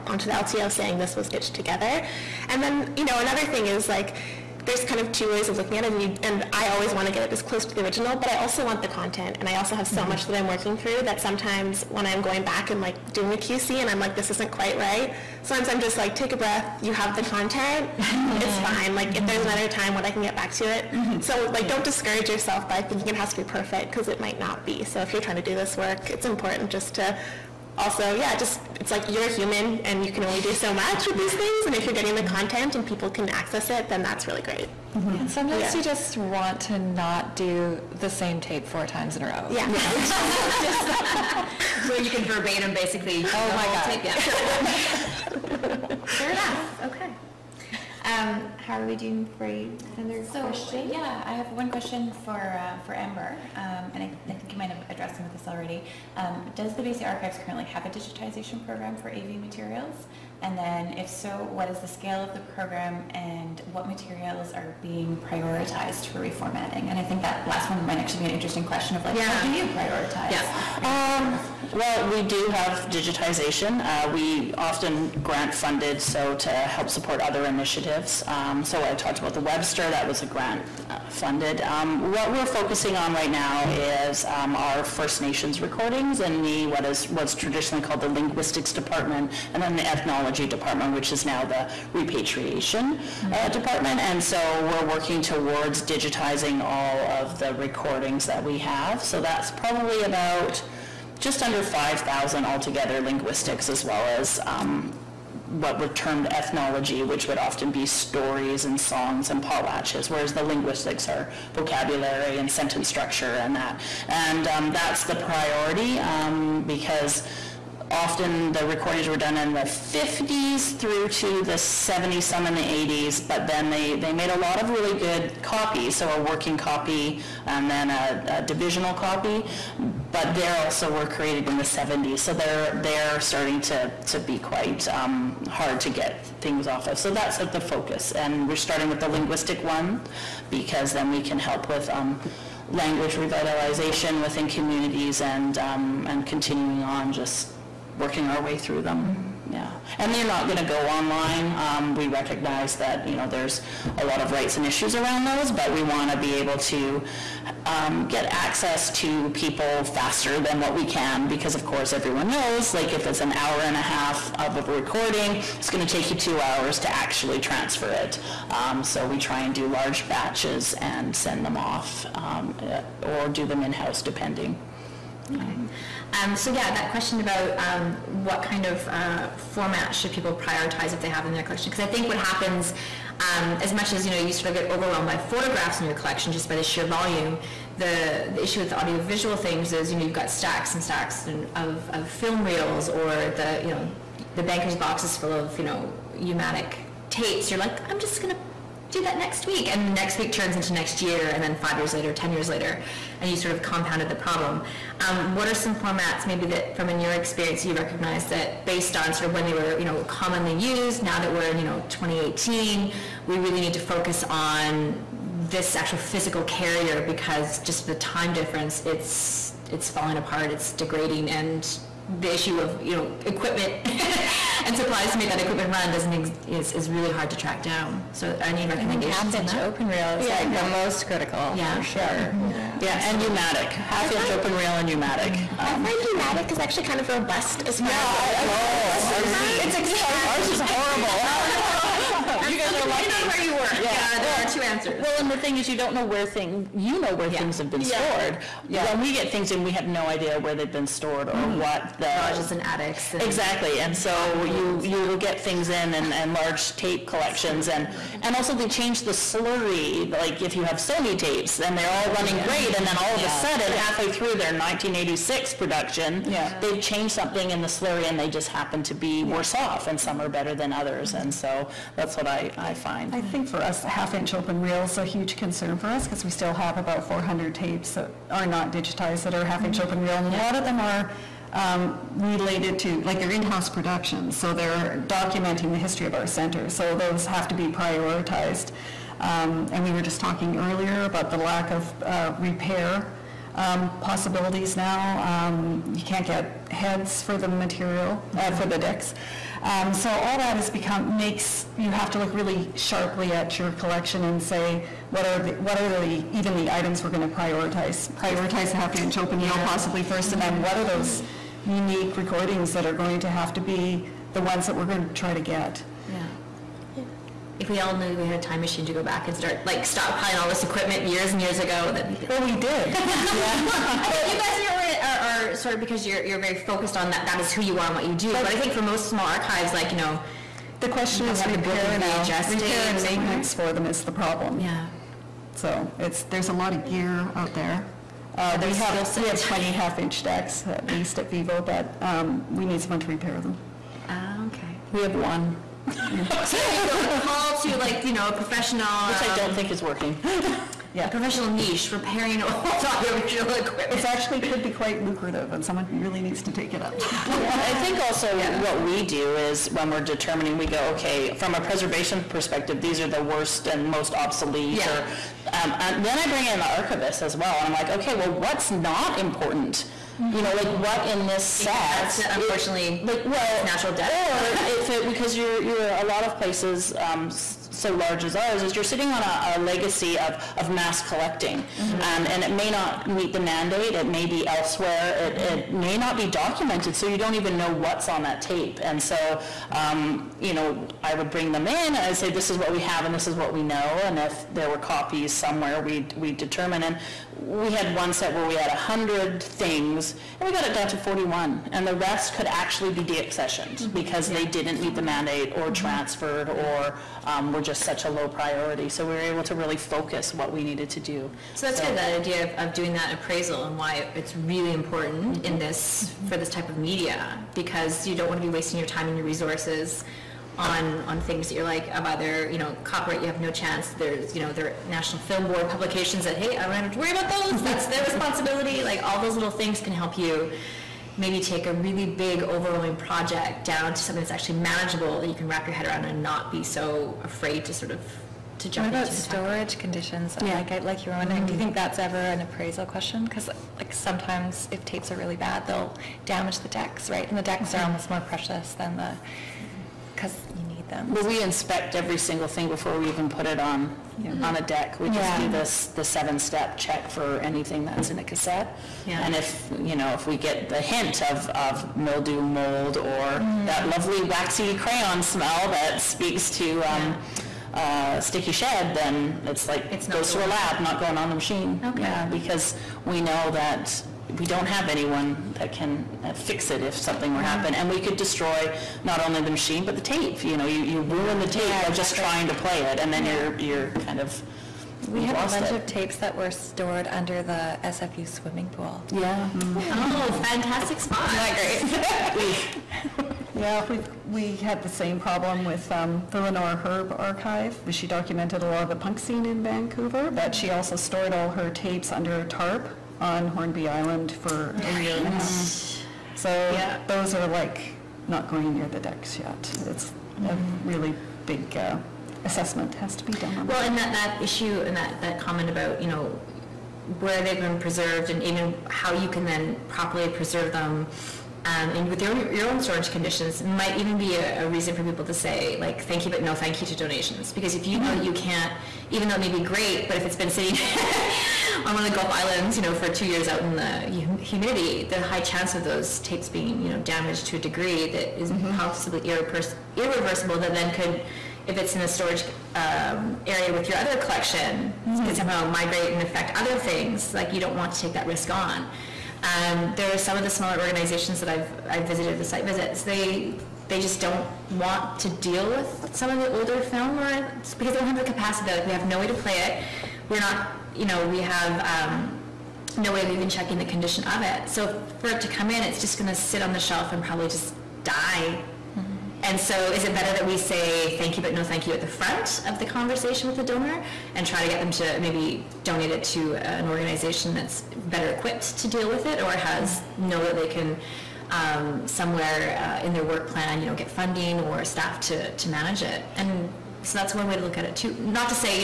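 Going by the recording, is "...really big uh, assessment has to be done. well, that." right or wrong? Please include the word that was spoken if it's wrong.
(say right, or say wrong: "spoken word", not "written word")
right.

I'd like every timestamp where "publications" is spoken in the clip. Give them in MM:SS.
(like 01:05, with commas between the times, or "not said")
07:05.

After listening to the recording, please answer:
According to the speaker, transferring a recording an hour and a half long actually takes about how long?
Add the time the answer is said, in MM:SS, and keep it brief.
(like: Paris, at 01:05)
2 hours, at 02:46.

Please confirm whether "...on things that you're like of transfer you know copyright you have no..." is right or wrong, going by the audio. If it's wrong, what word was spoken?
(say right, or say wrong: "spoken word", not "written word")
wrong: "either", not "transfer".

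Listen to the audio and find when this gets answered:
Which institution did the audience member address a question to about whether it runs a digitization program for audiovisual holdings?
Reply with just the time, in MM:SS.
00:56.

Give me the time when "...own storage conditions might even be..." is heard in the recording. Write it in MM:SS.
08:42.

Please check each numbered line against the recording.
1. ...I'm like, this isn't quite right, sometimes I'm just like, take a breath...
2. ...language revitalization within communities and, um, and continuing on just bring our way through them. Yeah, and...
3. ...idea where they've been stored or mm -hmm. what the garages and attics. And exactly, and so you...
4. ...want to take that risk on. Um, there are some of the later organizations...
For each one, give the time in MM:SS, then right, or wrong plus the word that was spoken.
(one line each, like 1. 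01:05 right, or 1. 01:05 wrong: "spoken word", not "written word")
1. 00:13 right
2. 02:22 wrong: "working", not "bring"
3. 04:10 right
4. 09:07 wrong: "smaller", not "later".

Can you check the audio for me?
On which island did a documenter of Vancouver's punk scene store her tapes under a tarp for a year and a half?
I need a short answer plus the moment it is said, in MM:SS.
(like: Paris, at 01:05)
Hornby Island, at 08:23.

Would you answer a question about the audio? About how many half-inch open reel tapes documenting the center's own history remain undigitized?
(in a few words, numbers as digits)
400.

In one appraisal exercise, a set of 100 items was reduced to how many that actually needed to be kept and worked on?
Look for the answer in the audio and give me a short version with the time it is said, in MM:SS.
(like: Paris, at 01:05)
41, at 06:40.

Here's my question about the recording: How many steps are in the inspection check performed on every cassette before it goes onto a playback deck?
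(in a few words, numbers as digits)
7.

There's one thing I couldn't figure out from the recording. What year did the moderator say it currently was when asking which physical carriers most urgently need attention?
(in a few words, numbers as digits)
2018.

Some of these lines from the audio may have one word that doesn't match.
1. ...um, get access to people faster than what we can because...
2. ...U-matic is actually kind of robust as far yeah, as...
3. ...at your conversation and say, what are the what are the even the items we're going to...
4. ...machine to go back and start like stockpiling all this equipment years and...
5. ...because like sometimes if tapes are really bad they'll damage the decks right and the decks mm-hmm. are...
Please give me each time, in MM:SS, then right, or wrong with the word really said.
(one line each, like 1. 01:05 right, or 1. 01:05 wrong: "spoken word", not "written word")
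1. 02:37 right
2. 03:56 right
3. 05:03 wrong: "collection", not "conversation"
4. 05:18 right
5. 07:23 right.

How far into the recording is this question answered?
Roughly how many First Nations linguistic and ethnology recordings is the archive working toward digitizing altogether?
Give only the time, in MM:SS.
01:41.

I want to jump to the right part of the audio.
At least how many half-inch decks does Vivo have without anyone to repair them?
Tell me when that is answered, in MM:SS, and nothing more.
05:39.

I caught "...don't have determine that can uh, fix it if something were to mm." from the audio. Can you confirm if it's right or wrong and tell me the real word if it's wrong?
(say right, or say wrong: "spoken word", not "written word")
wrong: "anyone", not "determine".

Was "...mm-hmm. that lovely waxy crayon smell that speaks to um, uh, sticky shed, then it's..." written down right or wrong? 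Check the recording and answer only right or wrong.
right.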